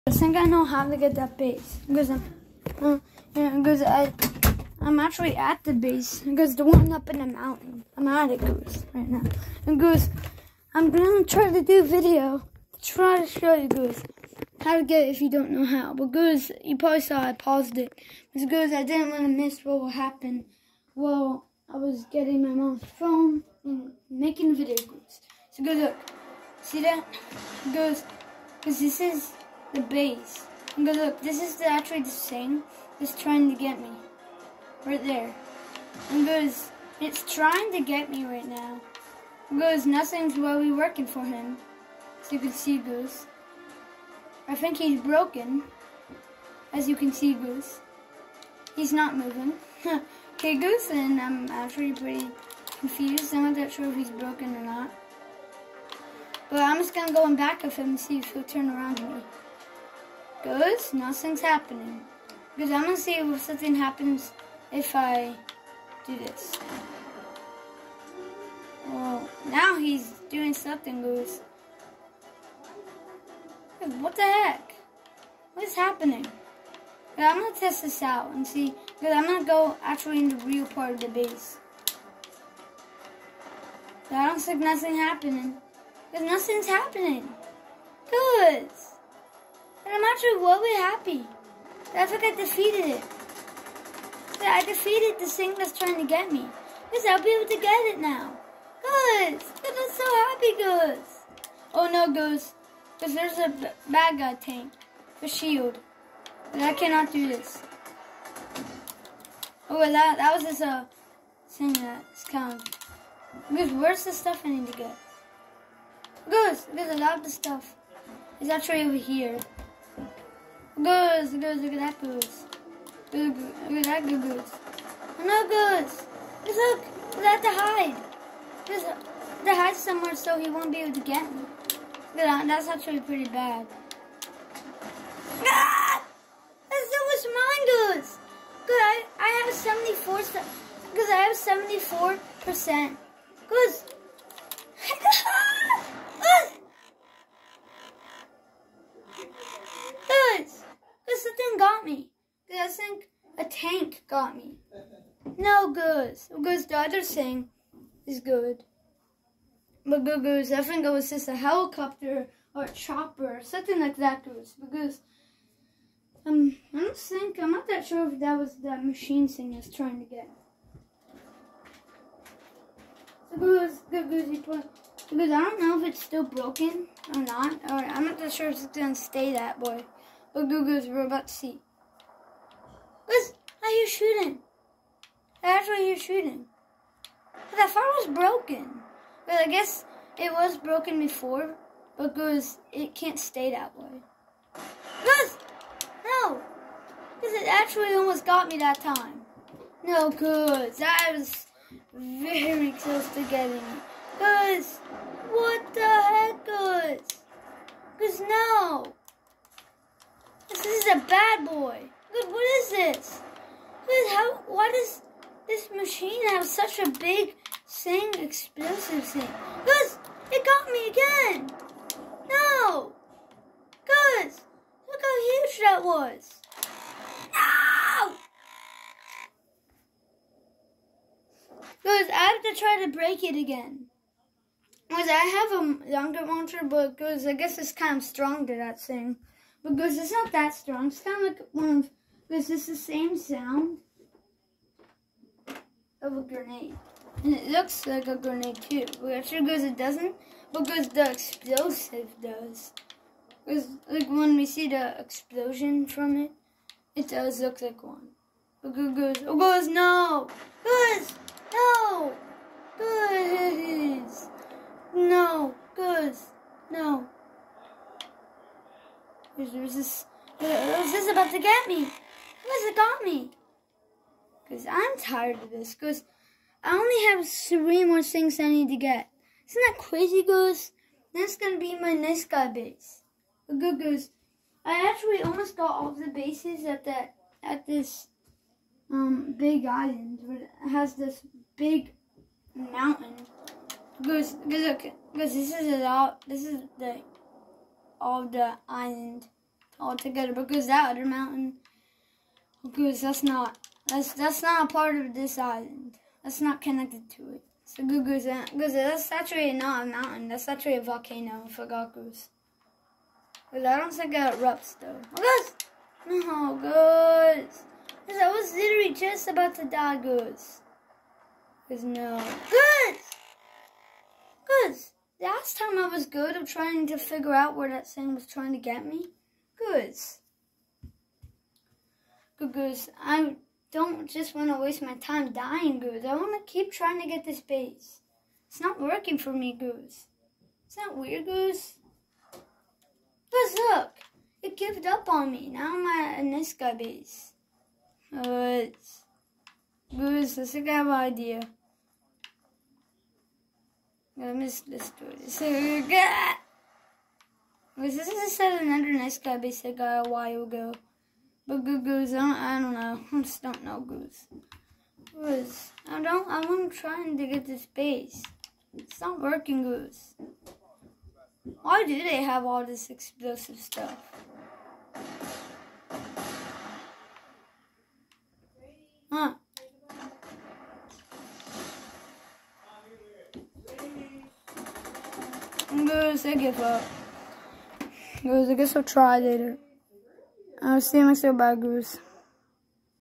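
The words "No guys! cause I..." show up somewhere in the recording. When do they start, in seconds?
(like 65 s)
316 s.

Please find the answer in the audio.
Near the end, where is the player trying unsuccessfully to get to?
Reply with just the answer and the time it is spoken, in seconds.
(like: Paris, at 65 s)
space, at 367 s.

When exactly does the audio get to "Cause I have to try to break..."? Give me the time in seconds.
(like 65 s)
231 s.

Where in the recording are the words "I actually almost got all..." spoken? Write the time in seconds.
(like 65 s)
284 s.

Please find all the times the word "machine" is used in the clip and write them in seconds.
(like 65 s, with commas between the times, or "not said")
168 s, 215 s.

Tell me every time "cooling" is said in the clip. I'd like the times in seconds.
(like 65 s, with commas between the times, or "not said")
not said.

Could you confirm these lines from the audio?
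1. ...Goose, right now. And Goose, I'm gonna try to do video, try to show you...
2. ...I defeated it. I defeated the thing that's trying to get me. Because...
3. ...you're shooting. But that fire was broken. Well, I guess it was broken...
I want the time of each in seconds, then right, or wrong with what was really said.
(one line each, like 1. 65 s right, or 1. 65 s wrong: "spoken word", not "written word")
1. 8 s right
2. 92 s right
3. 185 s right.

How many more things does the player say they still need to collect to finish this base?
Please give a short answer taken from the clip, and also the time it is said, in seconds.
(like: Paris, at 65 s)
3, at 277 s.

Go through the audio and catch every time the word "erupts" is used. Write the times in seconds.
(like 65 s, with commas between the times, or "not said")
314 s.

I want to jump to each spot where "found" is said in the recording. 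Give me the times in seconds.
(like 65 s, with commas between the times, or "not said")
not said.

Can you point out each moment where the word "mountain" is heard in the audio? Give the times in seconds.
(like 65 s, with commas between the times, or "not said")
7 s, 292 s, 301 s, 309 s.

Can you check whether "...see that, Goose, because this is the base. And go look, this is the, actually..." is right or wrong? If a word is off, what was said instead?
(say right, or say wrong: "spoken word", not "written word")
right.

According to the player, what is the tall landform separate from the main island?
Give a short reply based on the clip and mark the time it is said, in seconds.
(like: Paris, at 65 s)
a volcano, at 310 s.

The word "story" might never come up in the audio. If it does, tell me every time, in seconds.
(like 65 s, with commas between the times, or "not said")
354 s.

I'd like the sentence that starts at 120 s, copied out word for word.
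Goose, goose, look at that goose.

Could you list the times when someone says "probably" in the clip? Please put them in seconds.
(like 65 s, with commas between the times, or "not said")
16 s.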